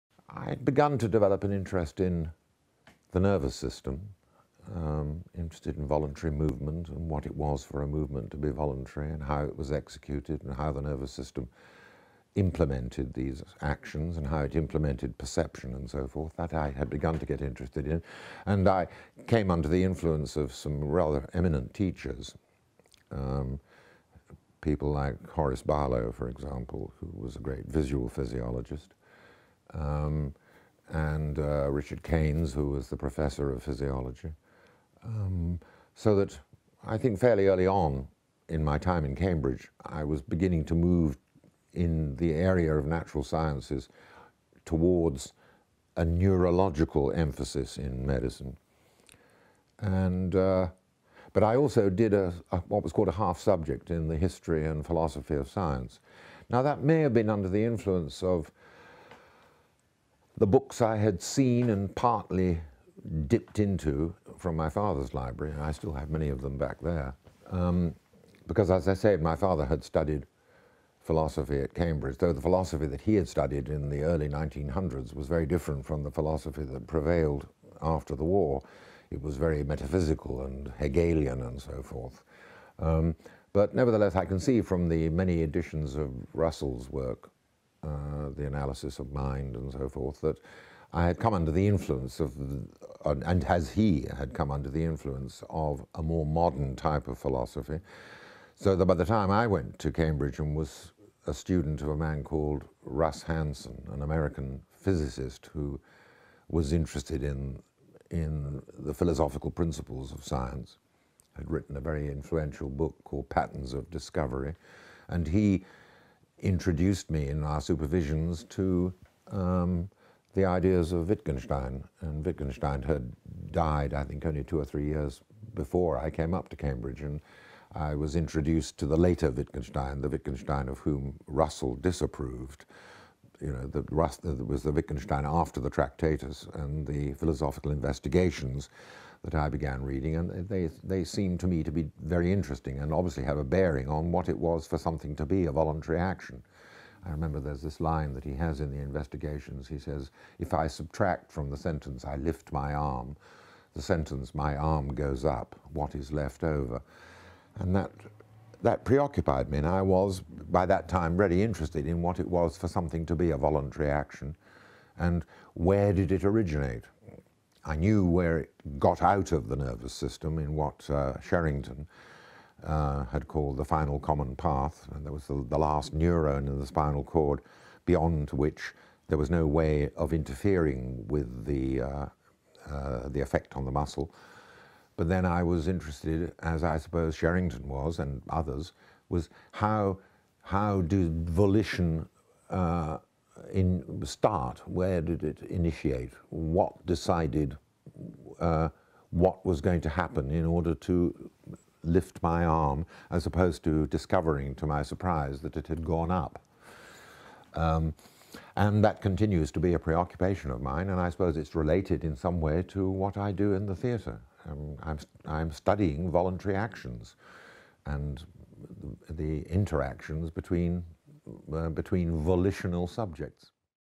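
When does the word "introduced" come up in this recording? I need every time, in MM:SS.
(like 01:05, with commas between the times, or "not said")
01:56, 02:08.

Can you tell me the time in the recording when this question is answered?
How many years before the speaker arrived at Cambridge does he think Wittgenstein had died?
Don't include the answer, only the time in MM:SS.
02:04.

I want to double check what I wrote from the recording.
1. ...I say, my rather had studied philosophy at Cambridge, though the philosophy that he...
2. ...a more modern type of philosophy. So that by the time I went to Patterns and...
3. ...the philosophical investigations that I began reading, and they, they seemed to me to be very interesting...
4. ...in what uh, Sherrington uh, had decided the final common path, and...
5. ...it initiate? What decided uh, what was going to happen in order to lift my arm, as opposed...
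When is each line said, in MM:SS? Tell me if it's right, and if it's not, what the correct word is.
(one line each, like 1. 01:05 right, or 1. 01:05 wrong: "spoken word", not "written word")
1. 01:08 wrong: "father", not "rather"
2. 01:35 wrong: "Cambridge", not "Patterns"
3. 02:16 right
4. 02:50 wrong: "called", not "decided"
5. 03:15 right.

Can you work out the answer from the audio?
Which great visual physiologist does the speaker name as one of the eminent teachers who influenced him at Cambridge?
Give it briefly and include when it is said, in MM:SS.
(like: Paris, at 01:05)
Horace Barlow, at 00:25.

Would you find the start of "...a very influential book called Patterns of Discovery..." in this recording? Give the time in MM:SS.
01:51.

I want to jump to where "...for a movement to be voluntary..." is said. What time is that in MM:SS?
00:07.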